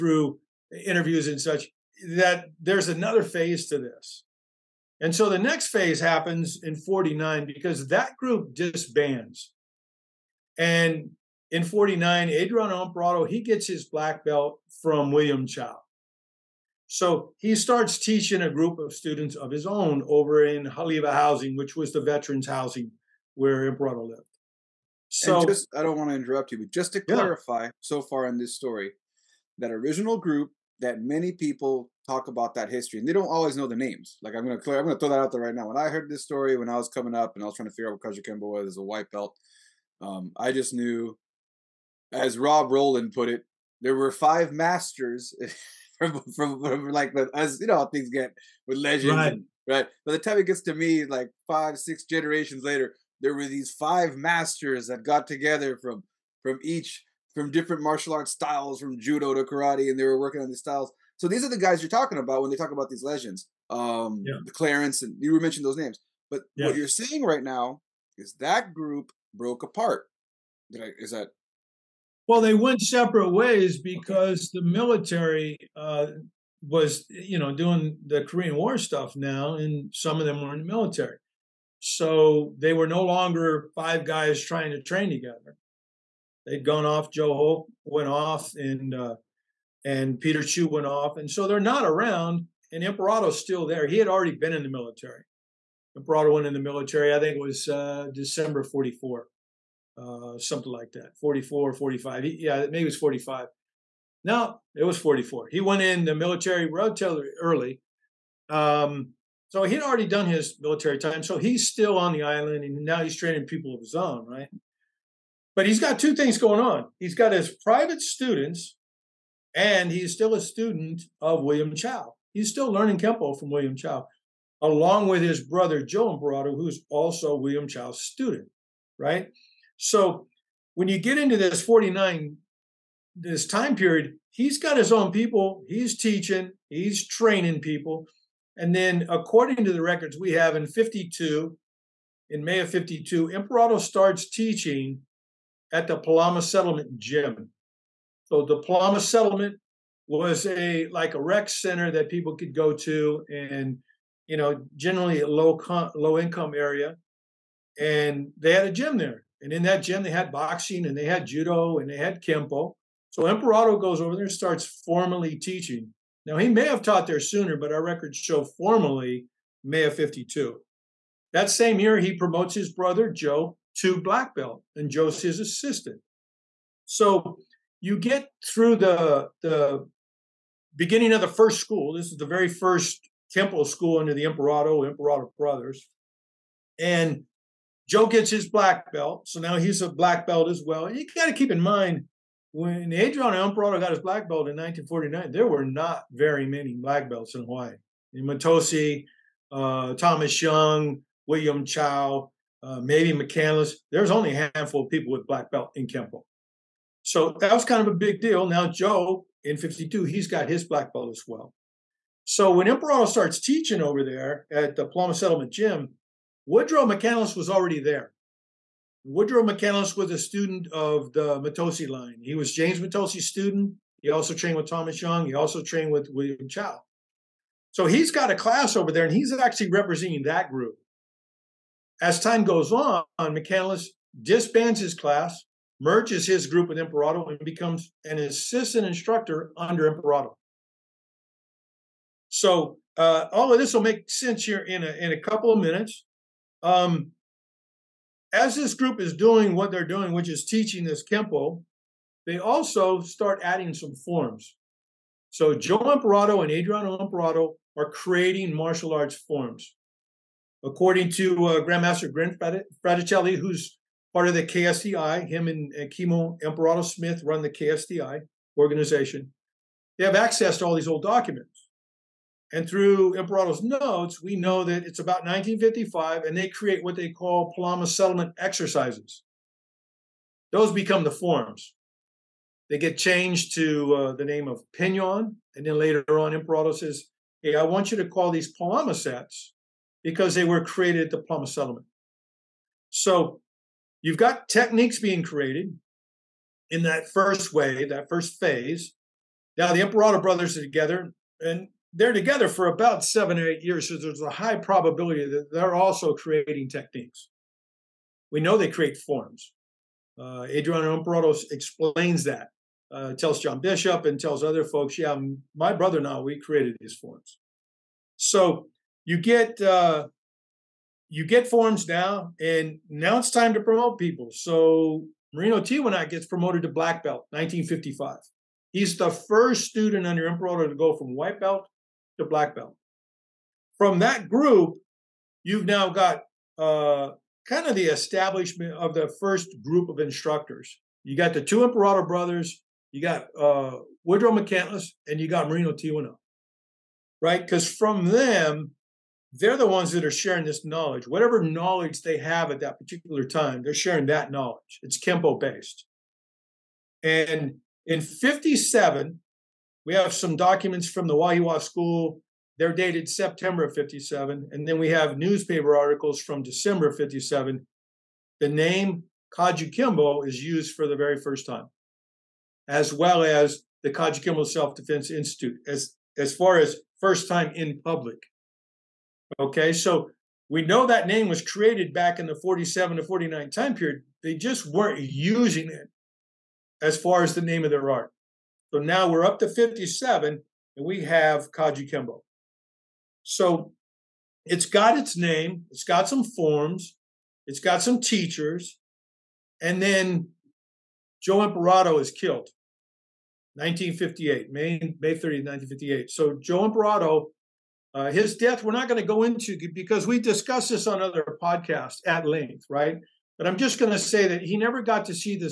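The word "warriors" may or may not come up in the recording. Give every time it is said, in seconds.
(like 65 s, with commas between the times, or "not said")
not said.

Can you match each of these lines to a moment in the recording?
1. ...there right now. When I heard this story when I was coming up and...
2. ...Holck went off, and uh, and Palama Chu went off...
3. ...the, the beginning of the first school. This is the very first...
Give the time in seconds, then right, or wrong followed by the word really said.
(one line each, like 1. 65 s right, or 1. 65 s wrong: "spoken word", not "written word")
1. 35 s right
2. 87 s wrong: "Peter", not "Palama"
3. 178 s right.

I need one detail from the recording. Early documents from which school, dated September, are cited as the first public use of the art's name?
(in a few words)
Wahiawa School.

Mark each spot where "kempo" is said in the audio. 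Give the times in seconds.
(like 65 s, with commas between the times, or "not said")
122 s, 162 s, 183 s, 205 s, 251 s, 355 s.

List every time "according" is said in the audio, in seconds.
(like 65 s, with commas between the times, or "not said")
139 s, 260 s.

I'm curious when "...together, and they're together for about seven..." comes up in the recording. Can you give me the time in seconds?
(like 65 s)
300 s.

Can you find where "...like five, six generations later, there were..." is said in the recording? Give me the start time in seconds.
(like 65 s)
51 s.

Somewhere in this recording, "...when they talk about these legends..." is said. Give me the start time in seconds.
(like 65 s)
62 s.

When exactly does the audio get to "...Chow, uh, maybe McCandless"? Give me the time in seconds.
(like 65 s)
201 s.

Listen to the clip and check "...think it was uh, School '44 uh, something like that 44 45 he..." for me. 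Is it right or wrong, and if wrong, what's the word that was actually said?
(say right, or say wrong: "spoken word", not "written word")
wrong: "December", not "School".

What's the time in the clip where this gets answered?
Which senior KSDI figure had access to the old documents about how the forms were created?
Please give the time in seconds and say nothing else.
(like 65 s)
261 s.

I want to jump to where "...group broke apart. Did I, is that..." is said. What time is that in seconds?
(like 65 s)
68 s.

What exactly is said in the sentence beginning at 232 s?
As time goes on, McCandless disbands his class, merges his group with Emperado, and becomes an assistant instructor under Emperado.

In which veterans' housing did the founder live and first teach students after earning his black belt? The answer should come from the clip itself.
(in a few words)
Halawa Housing.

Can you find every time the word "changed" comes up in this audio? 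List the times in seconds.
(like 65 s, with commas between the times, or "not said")
282 s.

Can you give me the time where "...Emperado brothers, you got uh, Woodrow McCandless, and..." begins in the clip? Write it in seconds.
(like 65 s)
341 s.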